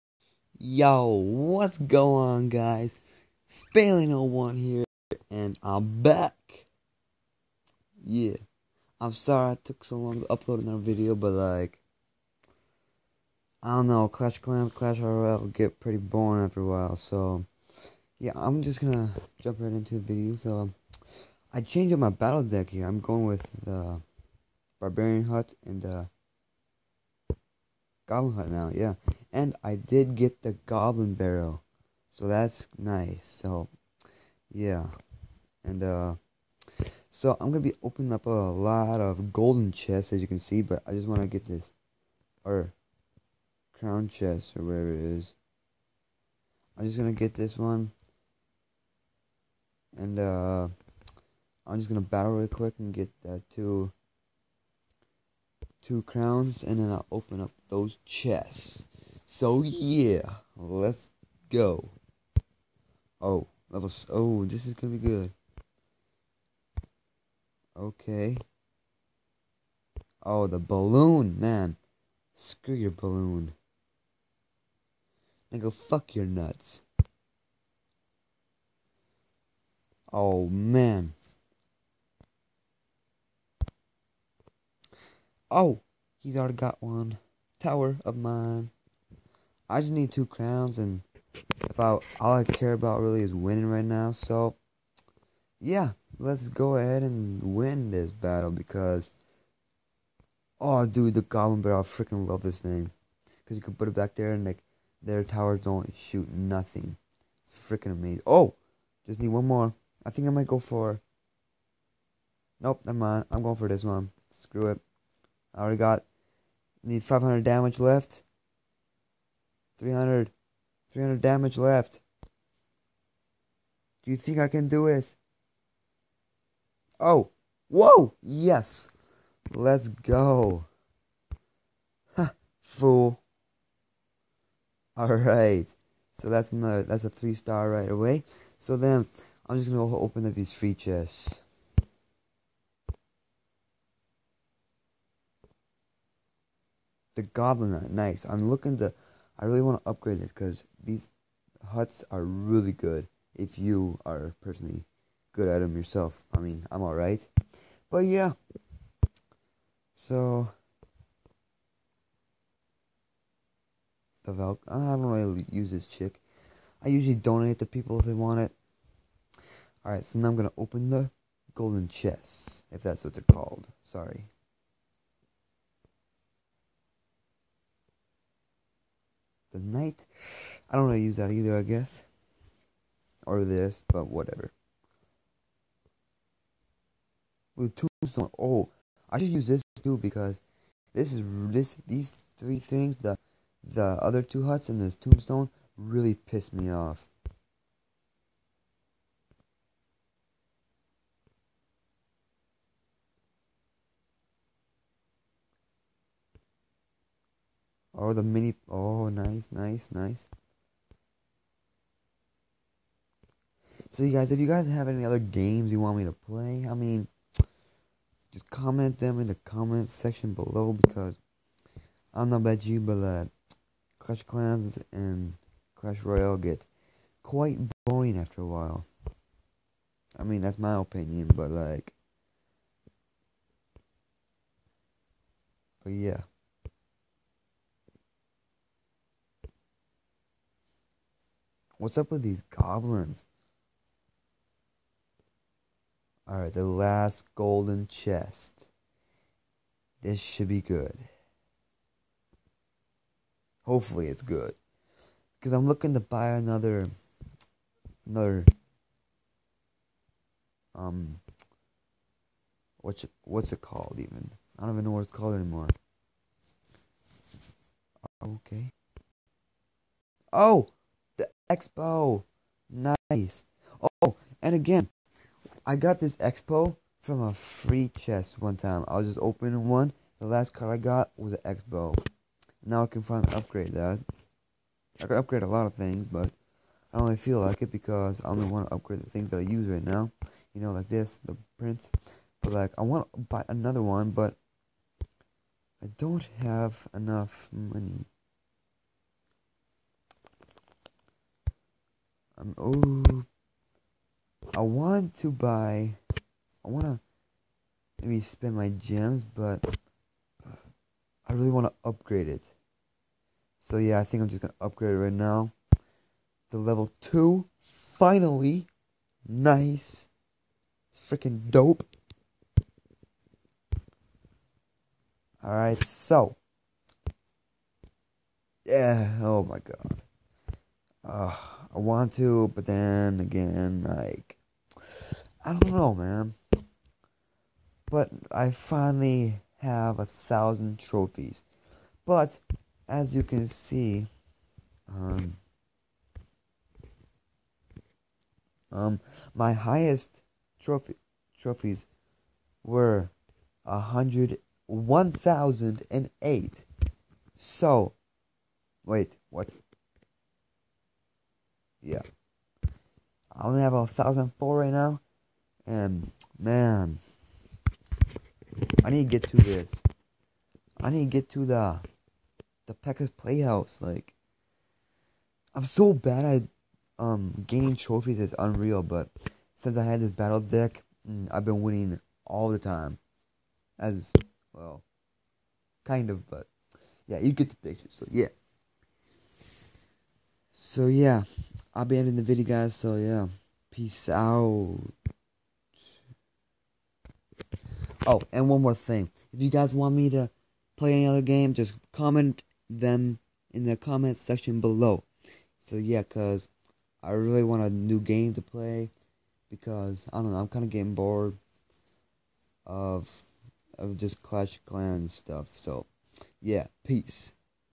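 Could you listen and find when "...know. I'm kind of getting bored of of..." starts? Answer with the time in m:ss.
6:50.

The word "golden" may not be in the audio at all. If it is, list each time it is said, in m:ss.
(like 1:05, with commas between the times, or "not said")
0:39, 2:51, 4:07.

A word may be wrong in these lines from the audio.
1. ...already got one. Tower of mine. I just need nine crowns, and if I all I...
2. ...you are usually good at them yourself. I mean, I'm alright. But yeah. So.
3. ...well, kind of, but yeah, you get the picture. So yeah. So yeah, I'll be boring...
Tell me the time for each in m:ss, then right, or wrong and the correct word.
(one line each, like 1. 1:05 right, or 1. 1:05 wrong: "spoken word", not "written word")
1. 1:26 wrong: "two", not "nine"
2. 2:33 wrong: "personally", not "usually"
3. 6:24 wrong: "ending", not "boring".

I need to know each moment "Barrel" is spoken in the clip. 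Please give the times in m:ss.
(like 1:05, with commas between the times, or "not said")
0:31, 1:41.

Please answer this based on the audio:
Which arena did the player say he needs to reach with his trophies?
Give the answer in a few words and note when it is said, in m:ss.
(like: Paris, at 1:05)
Pekka's Playhouse, at 6:12.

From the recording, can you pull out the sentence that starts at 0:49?
And, uh, I'm just going to battle real quick and get that too two crowns, and then I'll open up those chests.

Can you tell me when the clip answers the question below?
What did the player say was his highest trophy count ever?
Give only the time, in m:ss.
5:55.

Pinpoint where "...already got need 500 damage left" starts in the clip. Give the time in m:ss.
1:55.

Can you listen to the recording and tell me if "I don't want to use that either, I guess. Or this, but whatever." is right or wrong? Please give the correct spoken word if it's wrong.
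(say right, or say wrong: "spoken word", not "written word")
right.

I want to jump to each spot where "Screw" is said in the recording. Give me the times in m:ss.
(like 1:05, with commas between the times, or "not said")
1:12, 1:54.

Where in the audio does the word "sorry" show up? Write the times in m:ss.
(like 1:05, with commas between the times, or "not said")
0:09, 2:53.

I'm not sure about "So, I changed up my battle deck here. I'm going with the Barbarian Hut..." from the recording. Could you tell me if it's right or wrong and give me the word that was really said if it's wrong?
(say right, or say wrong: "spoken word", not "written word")
right.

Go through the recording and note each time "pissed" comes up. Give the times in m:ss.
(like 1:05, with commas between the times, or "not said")
3:16.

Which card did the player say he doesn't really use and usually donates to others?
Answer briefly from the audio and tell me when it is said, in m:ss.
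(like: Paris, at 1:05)
Val, at 2:44.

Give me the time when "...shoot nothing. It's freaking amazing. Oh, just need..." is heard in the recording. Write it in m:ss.
1:45.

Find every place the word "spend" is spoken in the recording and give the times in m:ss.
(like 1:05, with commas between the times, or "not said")
5:08.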